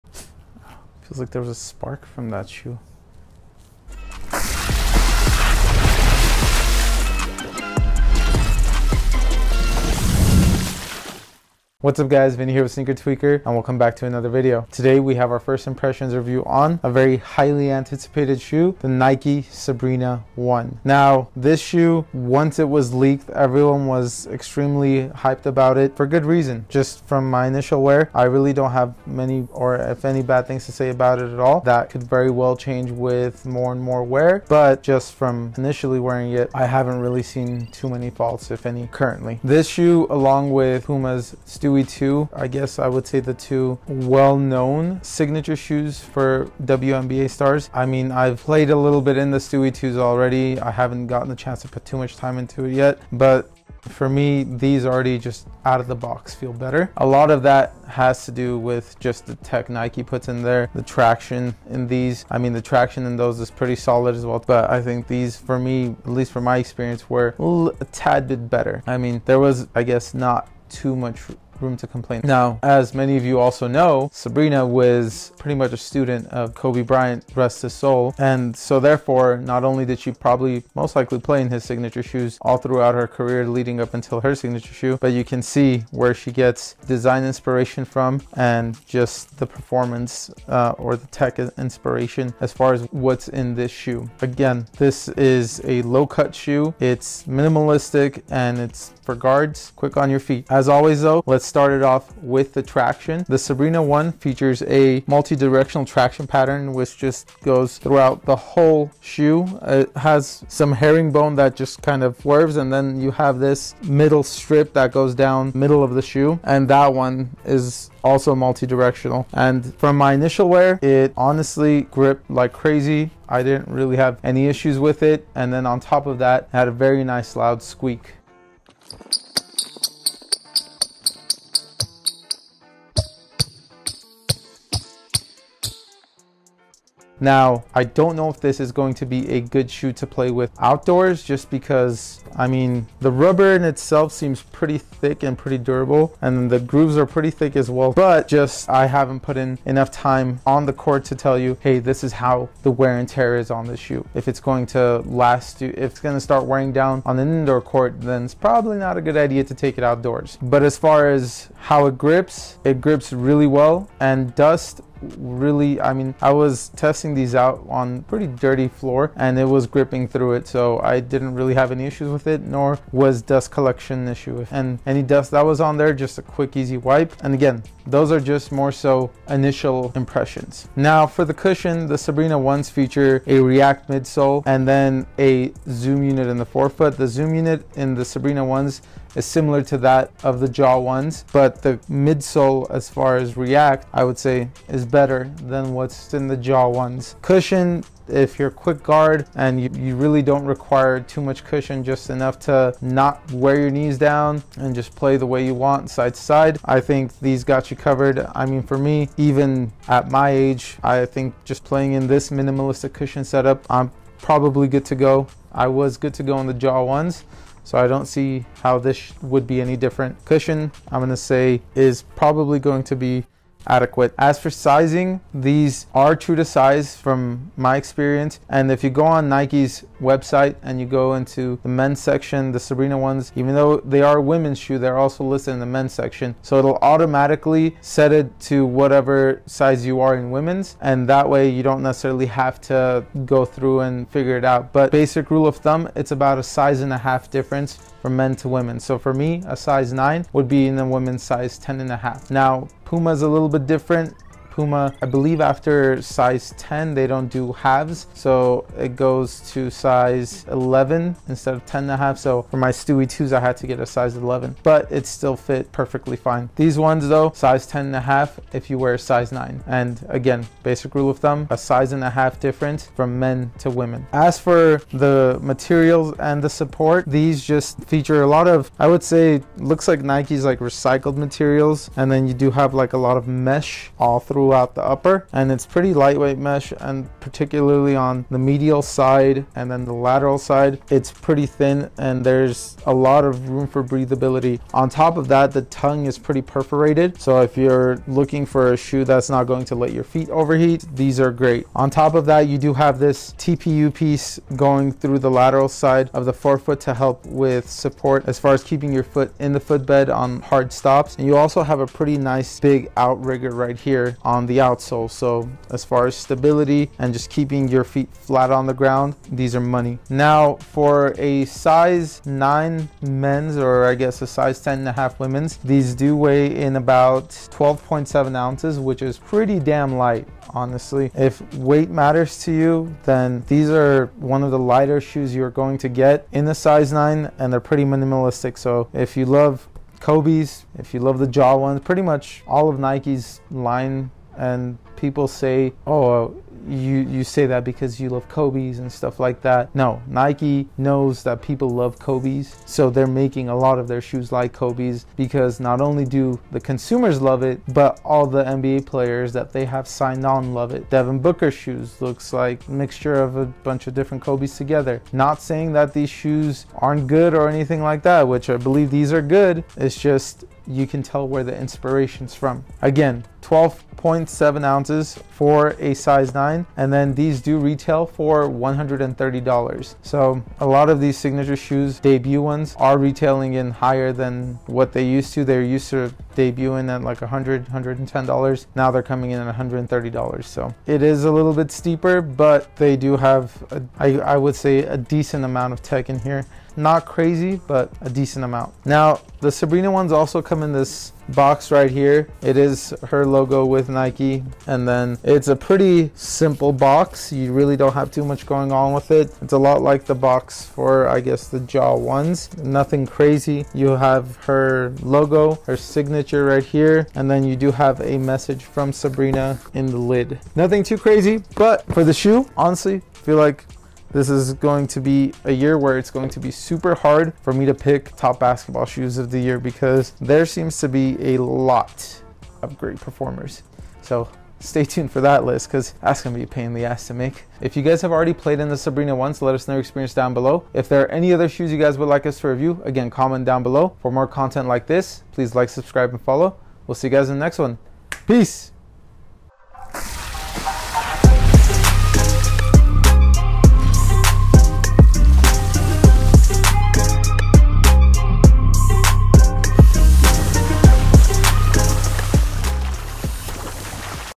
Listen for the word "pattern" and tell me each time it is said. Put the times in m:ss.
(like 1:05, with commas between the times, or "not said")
1:46.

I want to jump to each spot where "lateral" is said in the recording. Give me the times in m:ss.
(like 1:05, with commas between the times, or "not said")
4:49, 5:05.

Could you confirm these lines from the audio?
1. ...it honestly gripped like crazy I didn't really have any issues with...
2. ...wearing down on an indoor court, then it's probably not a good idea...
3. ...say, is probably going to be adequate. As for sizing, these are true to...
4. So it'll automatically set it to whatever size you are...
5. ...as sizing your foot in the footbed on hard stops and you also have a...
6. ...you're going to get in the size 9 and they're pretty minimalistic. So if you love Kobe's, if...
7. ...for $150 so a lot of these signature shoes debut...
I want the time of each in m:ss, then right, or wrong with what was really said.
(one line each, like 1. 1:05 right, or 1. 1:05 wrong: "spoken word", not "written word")
1. 2:00 right
2. 2:36 right
3. 3:41 right
4. 3:56 right
5. 5:08 wrong: "keeping", not "sizing"
6. 5:35 right
7. 6:18 wrong: "130", not "150".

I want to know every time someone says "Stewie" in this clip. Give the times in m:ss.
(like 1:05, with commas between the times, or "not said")
0:49, 4:22.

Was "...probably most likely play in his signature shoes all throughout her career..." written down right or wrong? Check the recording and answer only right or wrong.
right.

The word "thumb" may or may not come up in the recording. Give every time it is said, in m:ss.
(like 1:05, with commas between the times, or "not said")
4:05, 4:31.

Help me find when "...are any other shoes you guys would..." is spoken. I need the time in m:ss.
7:21.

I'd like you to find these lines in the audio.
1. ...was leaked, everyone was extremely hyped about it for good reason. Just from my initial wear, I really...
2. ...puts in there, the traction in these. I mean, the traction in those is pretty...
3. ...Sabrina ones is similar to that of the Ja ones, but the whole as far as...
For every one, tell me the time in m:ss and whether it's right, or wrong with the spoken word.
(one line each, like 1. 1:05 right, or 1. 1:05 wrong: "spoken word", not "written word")
1. 0:22 right
2. 1:00 right
3. 3:08 wrong: "midsole", not "whole".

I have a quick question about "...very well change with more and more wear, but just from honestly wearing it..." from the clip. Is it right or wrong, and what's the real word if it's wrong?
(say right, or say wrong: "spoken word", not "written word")
wrong: "initially", not "honestly".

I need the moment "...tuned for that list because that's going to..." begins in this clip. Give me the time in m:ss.
7:14.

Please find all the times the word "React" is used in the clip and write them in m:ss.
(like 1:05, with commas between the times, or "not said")
3:03, 3:13.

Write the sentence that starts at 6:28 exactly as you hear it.
Now they're coming in at $130.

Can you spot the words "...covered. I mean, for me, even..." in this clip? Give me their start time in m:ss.
3:27.